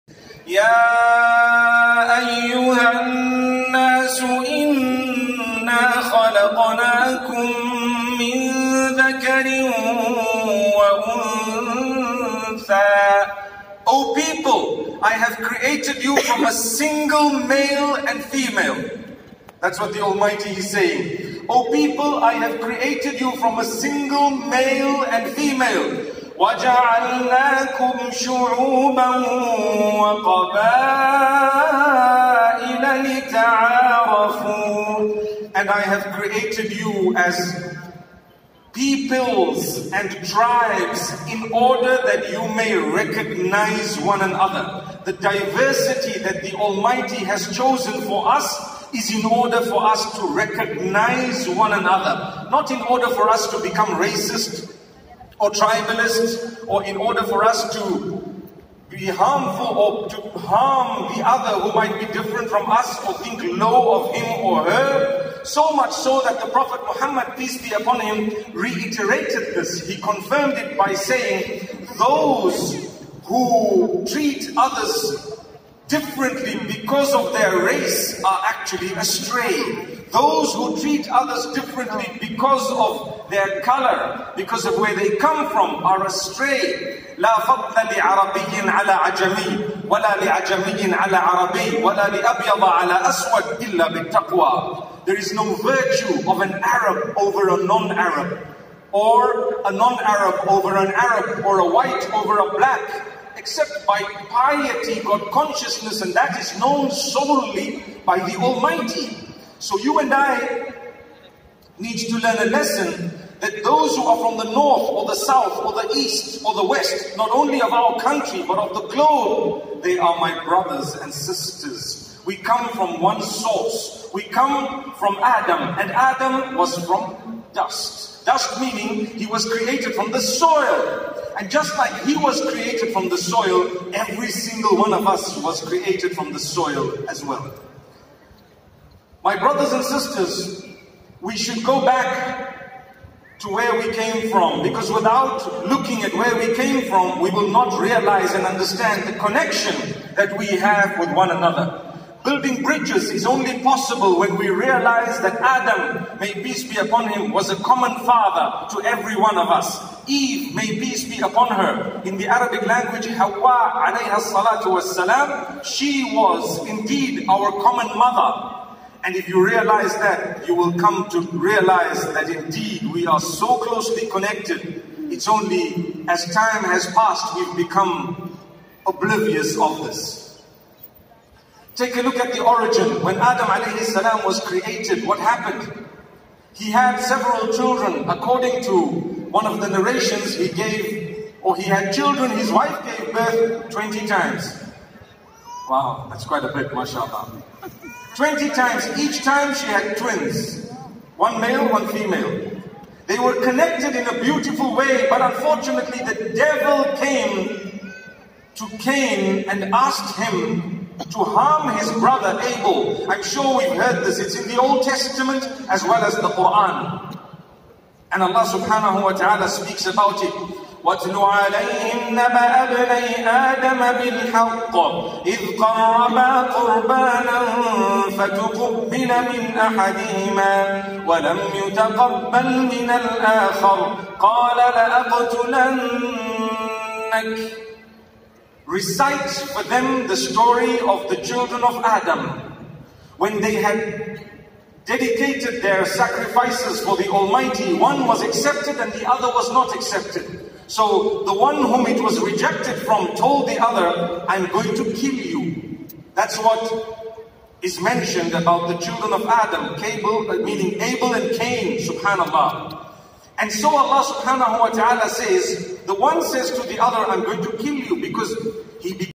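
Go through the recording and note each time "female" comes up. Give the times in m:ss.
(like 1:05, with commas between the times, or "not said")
0:18, 0:25, 3:21.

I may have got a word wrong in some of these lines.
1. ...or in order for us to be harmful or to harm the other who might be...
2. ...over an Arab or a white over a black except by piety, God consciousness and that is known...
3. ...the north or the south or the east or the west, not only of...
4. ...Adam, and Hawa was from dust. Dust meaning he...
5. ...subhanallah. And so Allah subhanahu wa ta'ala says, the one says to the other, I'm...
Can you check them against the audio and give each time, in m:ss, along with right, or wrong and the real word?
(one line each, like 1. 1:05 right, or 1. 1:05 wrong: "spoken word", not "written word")
1. 0:56 right
2. 1:40 right
3. 1:54 right
4. 2:05 wrong: "Adam", not "Hawa"
5. 4:21 right.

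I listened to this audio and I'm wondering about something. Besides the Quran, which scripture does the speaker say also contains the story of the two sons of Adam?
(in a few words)
Old Testament.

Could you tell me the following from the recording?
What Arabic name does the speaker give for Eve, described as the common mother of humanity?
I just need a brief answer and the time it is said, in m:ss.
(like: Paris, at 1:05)
Hawa, at 2:43.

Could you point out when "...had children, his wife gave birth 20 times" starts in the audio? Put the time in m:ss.
3:11.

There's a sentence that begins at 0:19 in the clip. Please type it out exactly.
That's what the Almighty is saying.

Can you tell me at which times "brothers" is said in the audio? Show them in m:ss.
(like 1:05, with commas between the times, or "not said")
2:00, 2:19, 3:31.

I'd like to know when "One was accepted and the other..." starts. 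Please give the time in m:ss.
4:07.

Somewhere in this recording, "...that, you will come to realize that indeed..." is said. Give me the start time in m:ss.
2:49.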